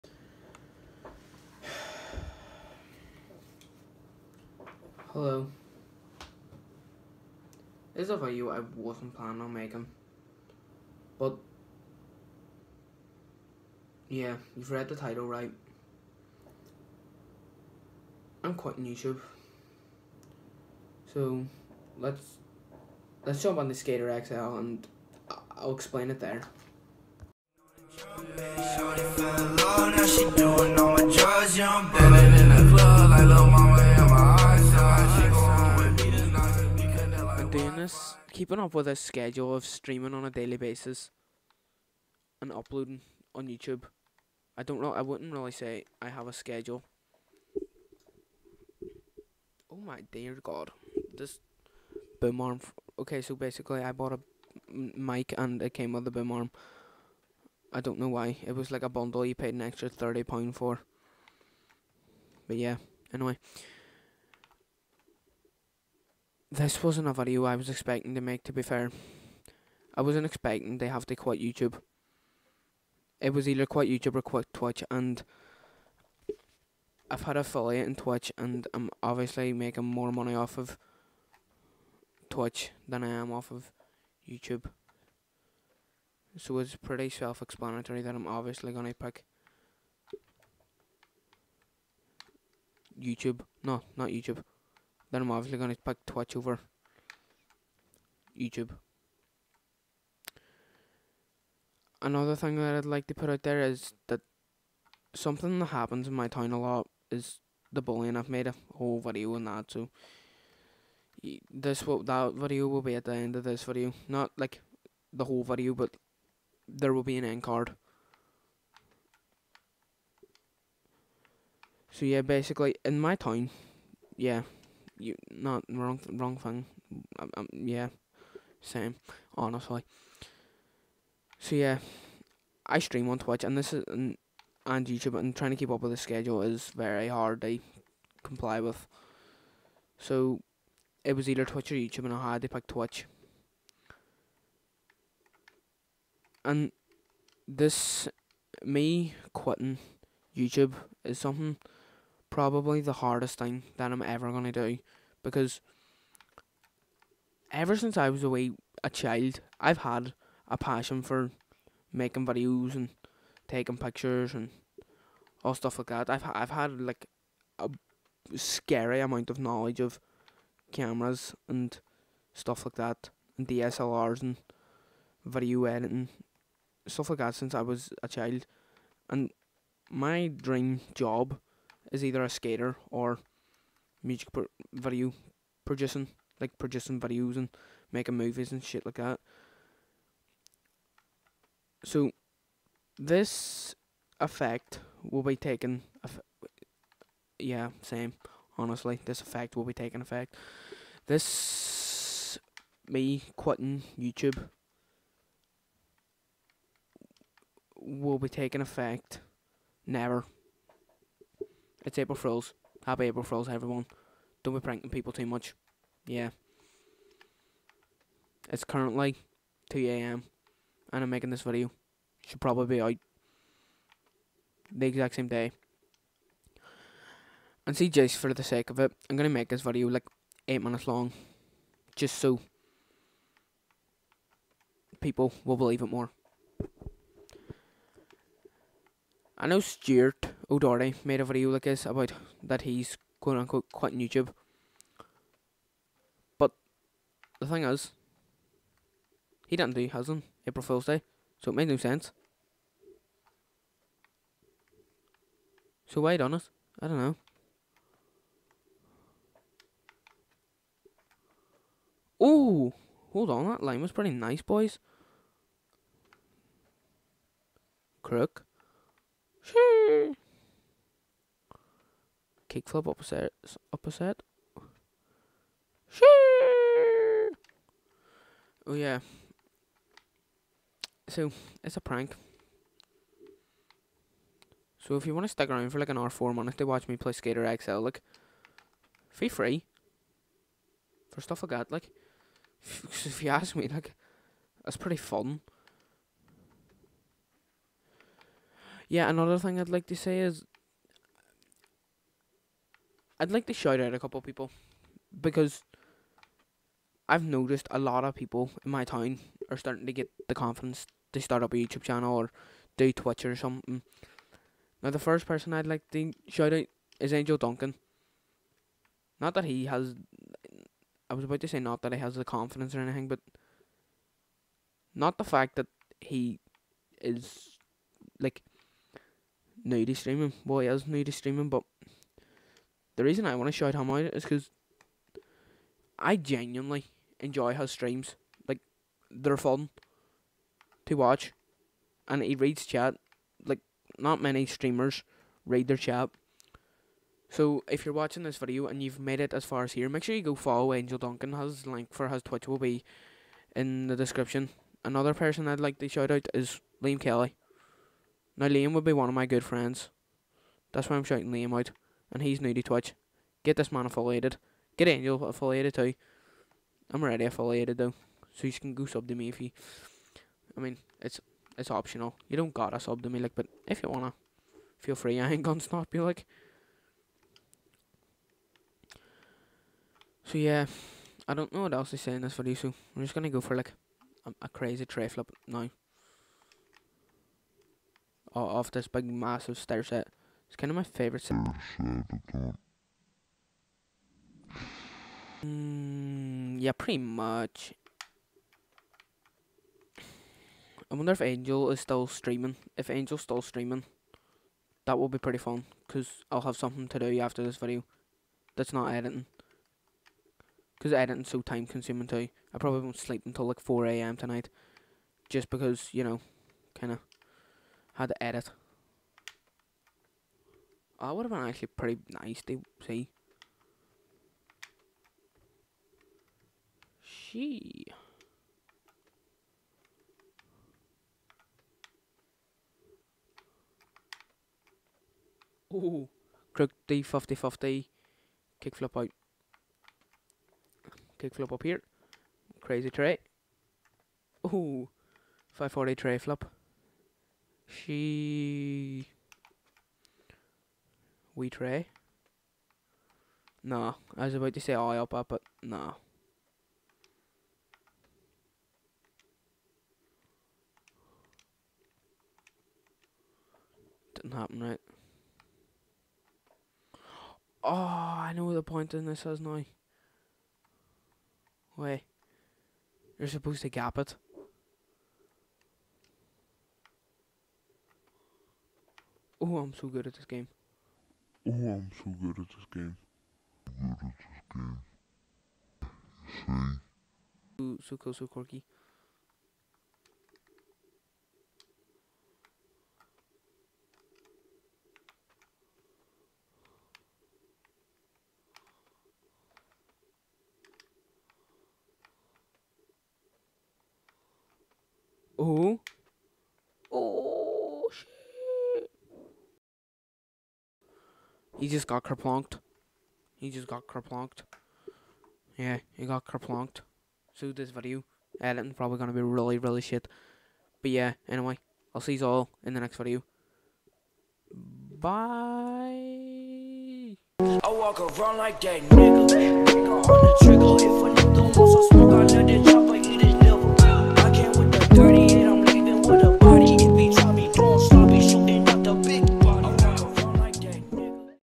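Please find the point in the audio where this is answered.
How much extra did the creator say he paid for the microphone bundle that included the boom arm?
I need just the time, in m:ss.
0:59.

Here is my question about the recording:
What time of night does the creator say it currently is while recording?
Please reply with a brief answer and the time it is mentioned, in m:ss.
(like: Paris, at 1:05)
2am, at 3:39.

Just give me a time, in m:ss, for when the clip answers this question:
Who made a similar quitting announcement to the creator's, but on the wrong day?
3:59.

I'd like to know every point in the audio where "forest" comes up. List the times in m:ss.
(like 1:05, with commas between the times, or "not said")
not said.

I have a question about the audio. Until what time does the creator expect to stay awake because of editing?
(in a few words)
4am.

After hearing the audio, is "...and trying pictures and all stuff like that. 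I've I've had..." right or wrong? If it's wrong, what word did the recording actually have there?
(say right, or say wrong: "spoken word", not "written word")
wrong: "taking", not "trying".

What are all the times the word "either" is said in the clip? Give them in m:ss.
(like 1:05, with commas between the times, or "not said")
1:13, 2:21, 3:02.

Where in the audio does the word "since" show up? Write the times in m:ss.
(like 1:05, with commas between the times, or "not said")
2:37, 2:57.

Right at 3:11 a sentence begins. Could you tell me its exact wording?
So, this effect will be taken.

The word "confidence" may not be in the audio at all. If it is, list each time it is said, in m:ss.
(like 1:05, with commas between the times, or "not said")
5:10, 5:22.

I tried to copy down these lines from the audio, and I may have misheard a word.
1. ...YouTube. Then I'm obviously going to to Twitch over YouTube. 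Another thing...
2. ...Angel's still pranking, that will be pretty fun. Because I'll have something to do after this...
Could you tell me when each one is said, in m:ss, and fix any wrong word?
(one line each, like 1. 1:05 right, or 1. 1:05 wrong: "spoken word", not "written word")
1. 1:34 right
2. 6:42 wrong: "streaming", not "pranking".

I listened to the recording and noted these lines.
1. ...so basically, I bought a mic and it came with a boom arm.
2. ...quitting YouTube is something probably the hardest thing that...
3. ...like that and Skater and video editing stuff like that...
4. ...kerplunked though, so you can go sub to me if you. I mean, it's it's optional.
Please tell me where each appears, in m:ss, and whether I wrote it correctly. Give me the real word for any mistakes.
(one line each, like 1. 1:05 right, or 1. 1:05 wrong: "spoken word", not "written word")
1. 0:53 right
2. 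2:29 right
3. 2:52 wrong: "DSLRs", not "Skater"
4. 6:07 wrong: "affiliated", not "kerplunked".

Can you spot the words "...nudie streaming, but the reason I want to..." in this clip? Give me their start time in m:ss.
5:30.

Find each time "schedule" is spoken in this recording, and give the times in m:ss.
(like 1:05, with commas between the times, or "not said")
0:38, 0:46, 2:15.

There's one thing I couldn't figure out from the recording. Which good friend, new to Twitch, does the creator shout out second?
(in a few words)
Liam Kelly.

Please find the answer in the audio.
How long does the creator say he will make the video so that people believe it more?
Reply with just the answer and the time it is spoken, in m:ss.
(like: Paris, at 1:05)
8 minutes, at 3:50.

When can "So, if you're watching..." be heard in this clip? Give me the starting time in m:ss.
5:47.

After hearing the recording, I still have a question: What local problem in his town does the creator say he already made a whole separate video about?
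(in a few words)
Bullying.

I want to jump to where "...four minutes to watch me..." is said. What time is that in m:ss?
4:46.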